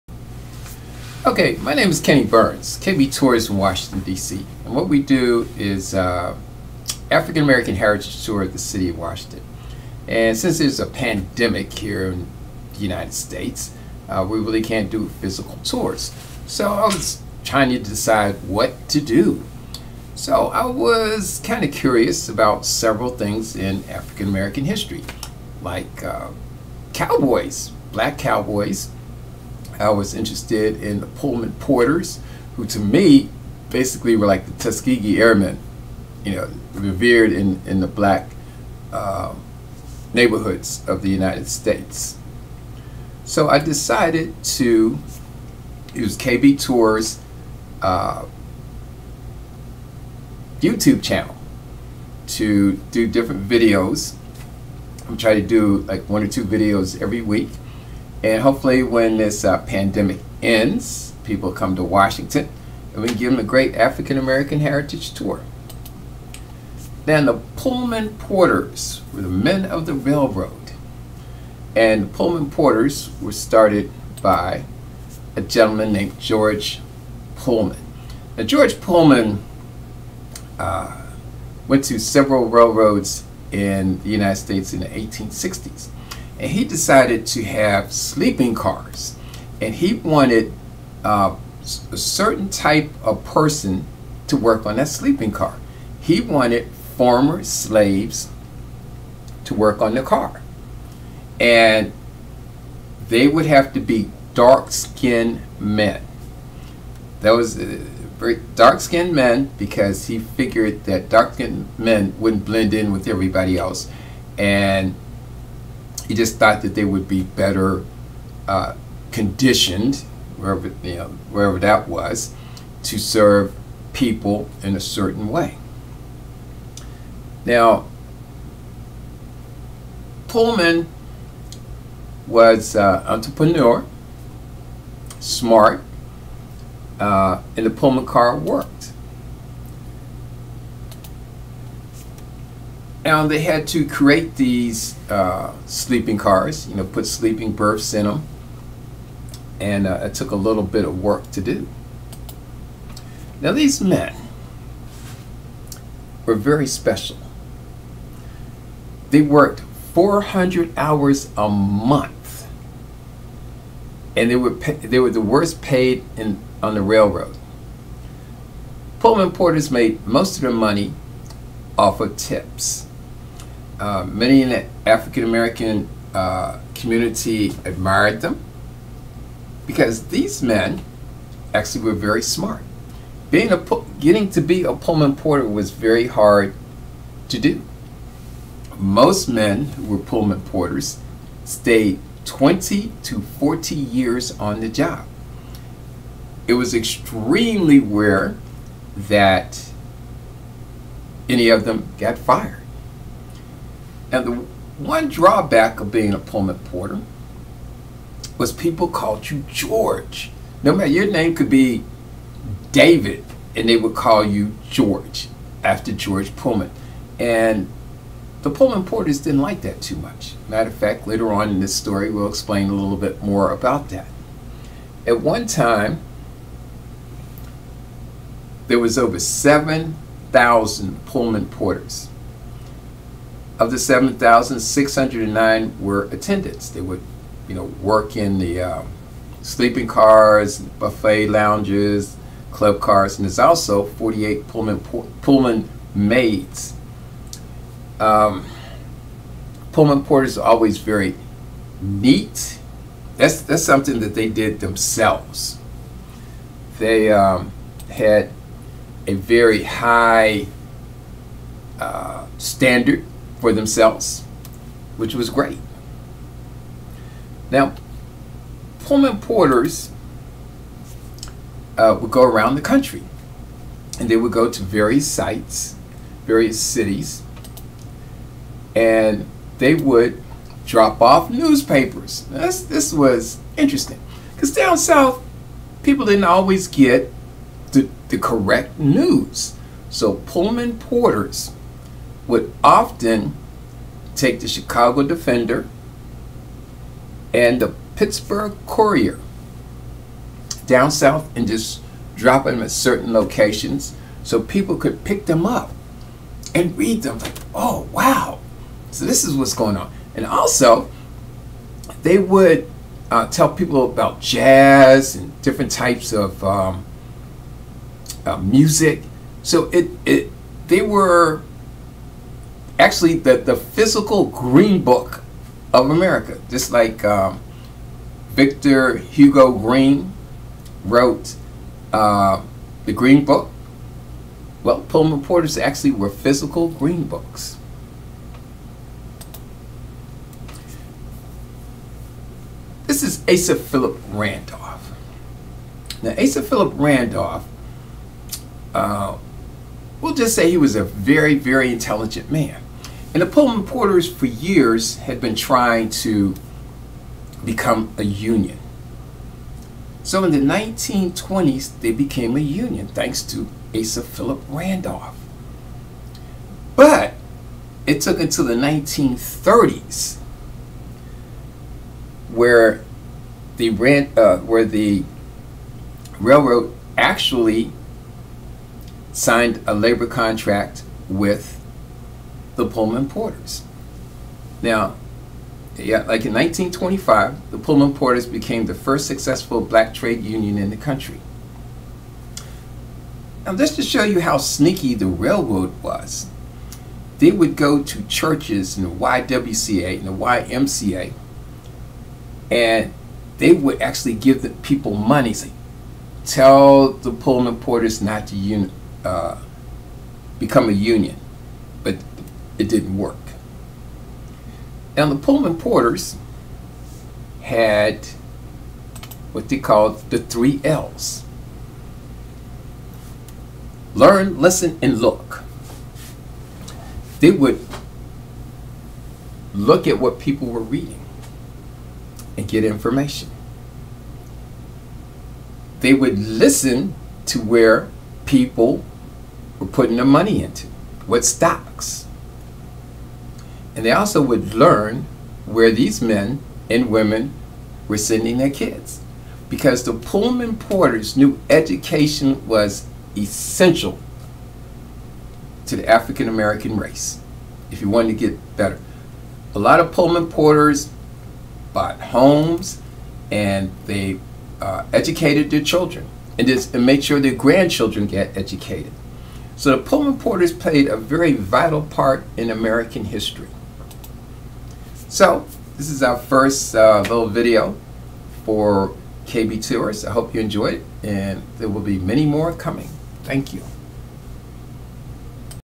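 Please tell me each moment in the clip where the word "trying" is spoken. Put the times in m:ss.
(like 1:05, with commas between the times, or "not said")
0:17, 0:55, 5:55.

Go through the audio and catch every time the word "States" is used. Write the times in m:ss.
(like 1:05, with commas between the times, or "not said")
0:13, 0:41, 1:24.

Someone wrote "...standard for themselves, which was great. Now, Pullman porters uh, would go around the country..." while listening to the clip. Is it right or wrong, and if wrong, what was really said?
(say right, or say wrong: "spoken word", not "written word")
right.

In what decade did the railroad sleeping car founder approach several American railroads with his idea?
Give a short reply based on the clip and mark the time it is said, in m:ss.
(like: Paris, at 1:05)
1860s, at 1:24.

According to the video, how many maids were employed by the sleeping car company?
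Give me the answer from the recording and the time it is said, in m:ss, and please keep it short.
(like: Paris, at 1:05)
48, at 4:03.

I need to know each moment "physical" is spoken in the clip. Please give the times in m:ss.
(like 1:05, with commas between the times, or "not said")
0:15, 5:23, 5:36.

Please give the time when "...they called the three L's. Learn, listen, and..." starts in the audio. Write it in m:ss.
6:59.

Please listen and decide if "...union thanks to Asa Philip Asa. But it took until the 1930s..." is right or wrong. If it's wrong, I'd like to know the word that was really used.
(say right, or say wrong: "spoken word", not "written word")
wrong: "Randolph", not "Asa".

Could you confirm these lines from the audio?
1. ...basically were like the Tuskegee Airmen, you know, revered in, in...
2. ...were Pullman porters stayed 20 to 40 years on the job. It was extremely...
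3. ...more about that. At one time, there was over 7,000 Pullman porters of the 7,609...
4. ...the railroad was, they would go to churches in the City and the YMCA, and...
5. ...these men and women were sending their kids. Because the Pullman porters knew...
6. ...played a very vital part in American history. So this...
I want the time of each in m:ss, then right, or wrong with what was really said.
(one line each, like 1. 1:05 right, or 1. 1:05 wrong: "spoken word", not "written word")
1. 0:33 right
2. 3:09 right
3. 3:43 right
4. 6:34 wrong: "YWCA", not "City"
5. 7:25 right
6. 7:50 right.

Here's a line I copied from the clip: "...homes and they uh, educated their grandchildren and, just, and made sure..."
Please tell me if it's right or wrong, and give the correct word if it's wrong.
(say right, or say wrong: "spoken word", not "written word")
wrong: "children", not "grandchildren".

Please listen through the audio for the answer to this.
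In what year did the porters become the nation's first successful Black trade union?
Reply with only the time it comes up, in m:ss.
6:26.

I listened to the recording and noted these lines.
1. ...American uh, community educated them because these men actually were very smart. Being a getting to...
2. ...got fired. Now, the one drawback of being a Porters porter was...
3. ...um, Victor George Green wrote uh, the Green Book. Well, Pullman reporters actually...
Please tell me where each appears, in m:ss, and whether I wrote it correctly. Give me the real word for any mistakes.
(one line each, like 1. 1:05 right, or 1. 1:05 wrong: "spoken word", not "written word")
1. 2:55 wrong: "admired", not "educated"
2. 3:21 wrong: "Pullman", not "Porters"
3. 5:27 wrong: "Hugo", not "George".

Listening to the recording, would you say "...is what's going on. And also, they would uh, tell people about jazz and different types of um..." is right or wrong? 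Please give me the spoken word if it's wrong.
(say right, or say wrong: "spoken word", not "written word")
right.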